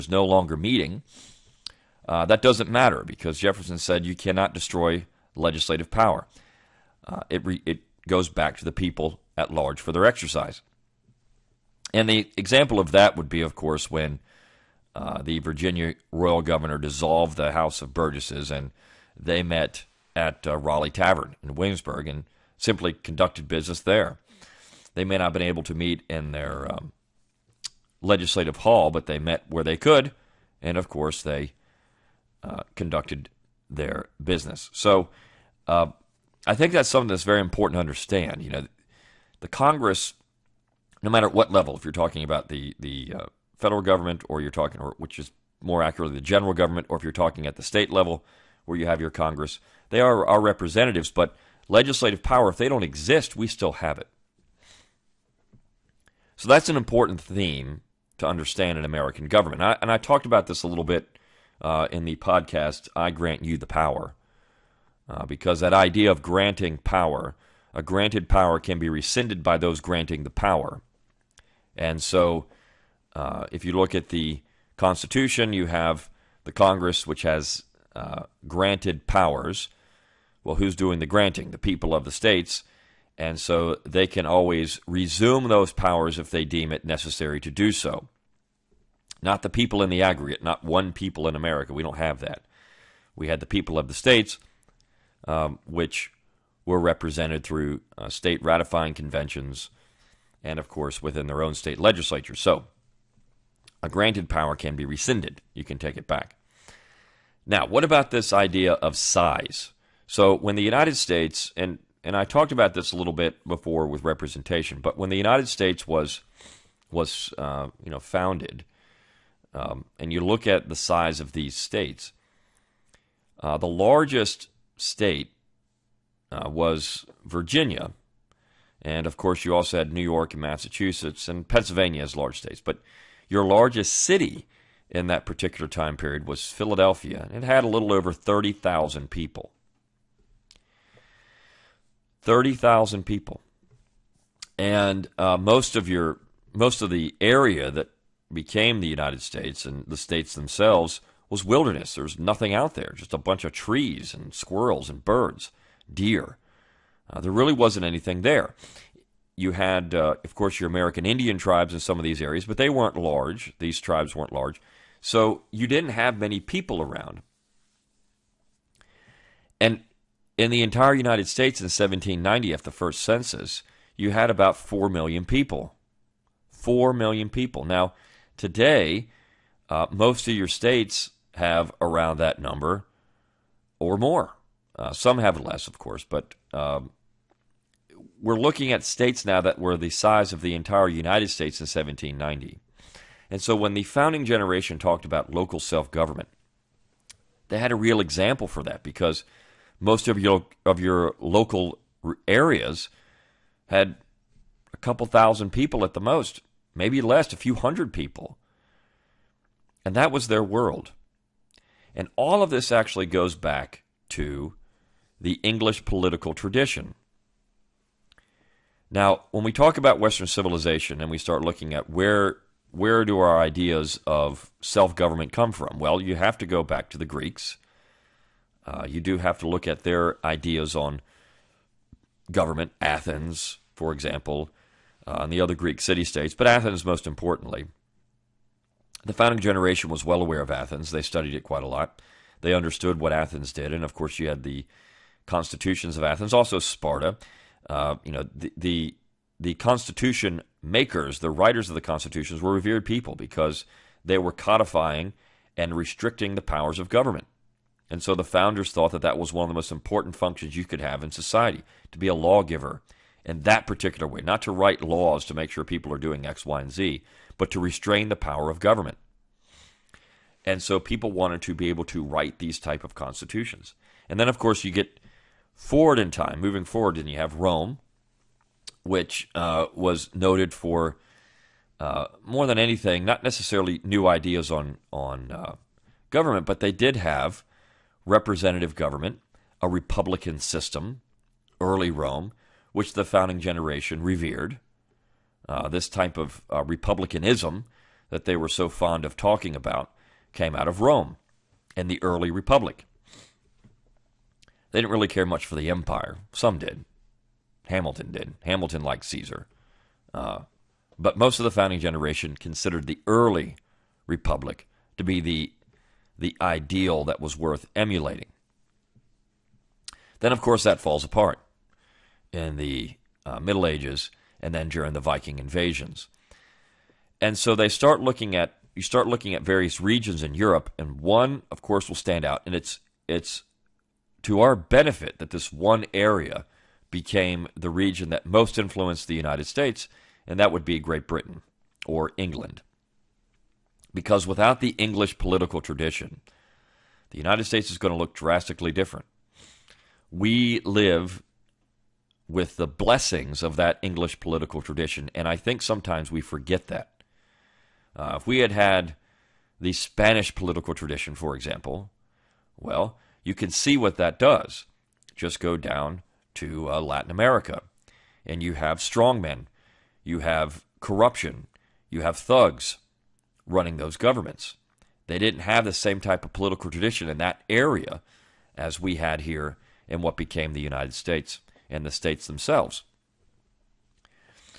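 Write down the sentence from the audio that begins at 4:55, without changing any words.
Uh, this type of uh, republicanism that they were so fond of talking about came out of Rome and the early republic.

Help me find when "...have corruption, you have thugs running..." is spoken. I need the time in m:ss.
6:10.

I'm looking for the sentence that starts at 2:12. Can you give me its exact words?
But your largest city in that particular time period was Philadelphia.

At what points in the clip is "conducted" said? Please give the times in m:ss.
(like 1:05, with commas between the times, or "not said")
0:22, 0:32.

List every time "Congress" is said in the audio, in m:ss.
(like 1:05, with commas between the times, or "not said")
0:39, 0:49, 1:16.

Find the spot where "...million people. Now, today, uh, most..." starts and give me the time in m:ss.
2:56.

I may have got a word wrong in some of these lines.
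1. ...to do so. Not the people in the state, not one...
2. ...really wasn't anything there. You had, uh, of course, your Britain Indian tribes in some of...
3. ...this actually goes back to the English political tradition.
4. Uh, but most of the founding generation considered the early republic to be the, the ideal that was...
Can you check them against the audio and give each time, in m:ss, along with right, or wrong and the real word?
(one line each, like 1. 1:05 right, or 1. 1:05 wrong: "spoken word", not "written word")
1. 1:27 wrong: "aggregate", not "state"
2. 2:37 wrong: "American", not "Britain"
3. 3:32 right
4. 5:10 right.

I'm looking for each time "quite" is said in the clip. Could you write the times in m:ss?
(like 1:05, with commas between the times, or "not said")
4:01.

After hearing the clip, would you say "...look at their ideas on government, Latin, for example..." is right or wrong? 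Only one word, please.
wrong.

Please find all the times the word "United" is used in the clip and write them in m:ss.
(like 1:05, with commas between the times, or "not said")
1:50, 1:55, 2:28, 2:50, 3:10, 5:39, 5:47, 6:20.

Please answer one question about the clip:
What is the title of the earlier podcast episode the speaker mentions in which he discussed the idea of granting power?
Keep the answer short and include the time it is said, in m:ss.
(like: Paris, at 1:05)
I Grant You the Power, at 1:02.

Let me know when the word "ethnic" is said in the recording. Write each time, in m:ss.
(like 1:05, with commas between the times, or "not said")
not said.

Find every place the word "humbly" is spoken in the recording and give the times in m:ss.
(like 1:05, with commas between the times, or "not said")
not said.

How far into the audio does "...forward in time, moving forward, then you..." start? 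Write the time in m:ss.
4:35.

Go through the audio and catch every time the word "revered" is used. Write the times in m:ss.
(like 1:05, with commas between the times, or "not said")
4:12, 4:54.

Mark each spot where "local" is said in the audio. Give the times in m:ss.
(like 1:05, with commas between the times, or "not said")
3:15, 3:21.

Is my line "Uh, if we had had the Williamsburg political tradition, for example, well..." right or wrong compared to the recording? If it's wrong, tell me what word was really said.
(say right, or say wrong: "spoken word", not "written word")
wrong: "Spanish", not "Williamsburg".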